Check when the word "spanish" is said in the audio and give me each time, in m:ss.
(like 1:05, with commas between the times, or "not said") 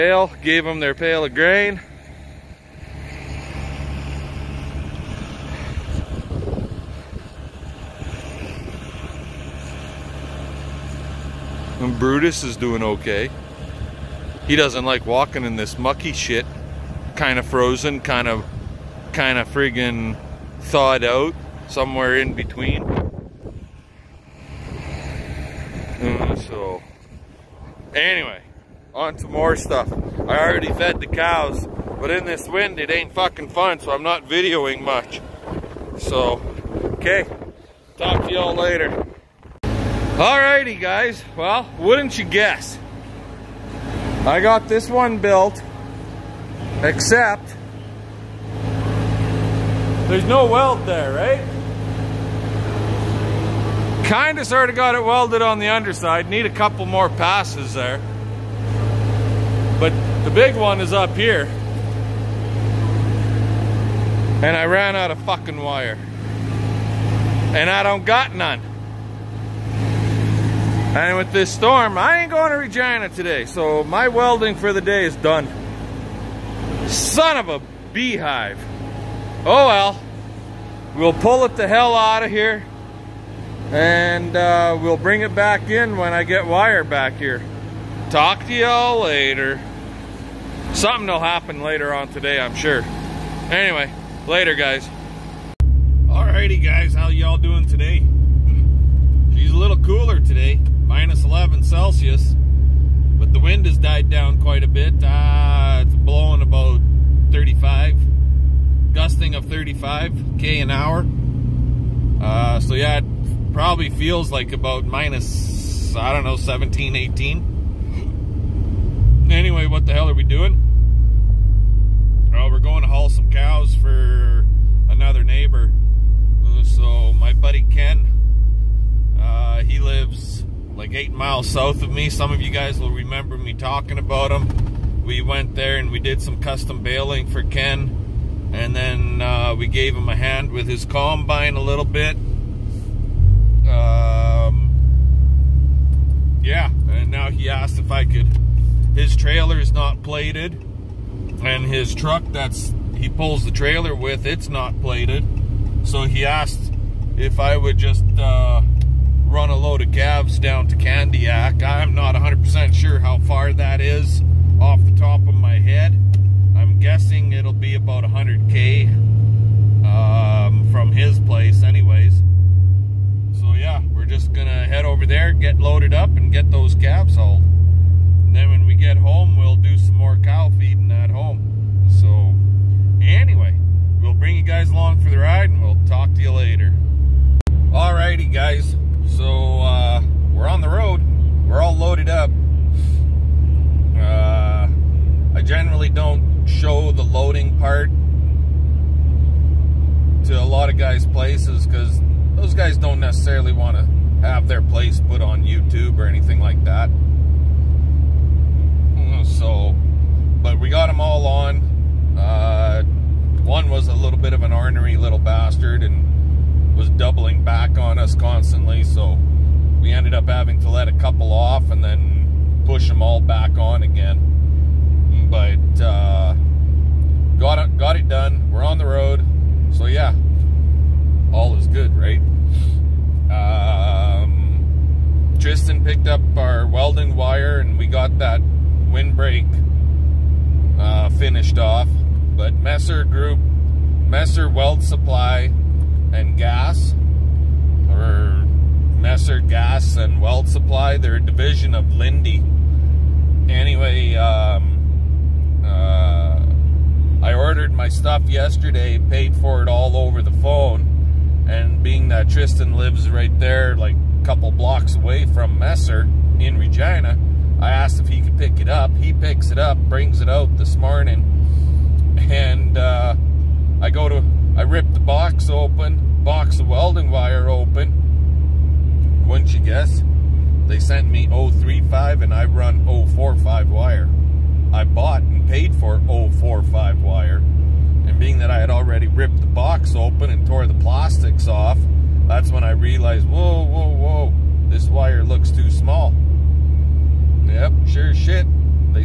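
not said.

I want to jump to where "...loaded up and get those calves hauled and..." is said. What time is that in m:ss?
2:55.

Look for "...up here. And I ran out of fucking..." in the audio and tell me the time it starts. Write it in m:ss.
1:00.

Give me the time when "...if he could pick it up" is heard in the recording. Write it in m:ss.
4:28.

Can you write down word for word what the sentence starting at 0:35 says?
So, okay, talk to y'all later.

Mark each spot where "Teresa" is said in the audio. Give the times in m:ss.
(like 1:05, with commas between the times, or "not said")
not said.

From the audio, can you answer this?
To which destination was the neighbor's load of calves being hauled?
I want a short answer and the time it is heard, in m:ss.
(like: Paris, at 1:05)
Candiac, at 2:40.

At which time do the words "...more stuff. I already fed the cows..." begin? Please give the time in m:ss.
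0:29.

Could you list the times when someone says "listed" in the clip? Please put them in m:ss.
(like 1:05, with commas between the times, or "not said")
not said.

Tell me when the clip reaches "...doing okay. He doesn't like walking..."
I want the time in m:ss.
0:12.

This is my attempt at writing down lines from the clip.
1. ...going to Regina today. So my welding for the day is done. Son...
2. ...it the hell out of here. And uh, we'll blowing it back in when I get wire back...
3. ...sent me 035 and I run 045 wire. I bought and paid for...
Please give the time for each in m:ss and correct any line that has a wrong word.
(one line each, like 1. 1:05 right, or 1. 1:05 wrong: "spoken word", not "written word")
1. 1:12 right
2. 1:21 wrong: "bring", not "blowing"
3. 4:40 right.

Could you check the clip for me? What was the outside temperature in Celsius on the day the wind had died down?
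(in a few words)
-11.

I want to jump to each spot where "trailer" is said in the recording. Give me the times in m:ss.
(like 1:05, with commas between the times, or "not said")
2:29, 2:33.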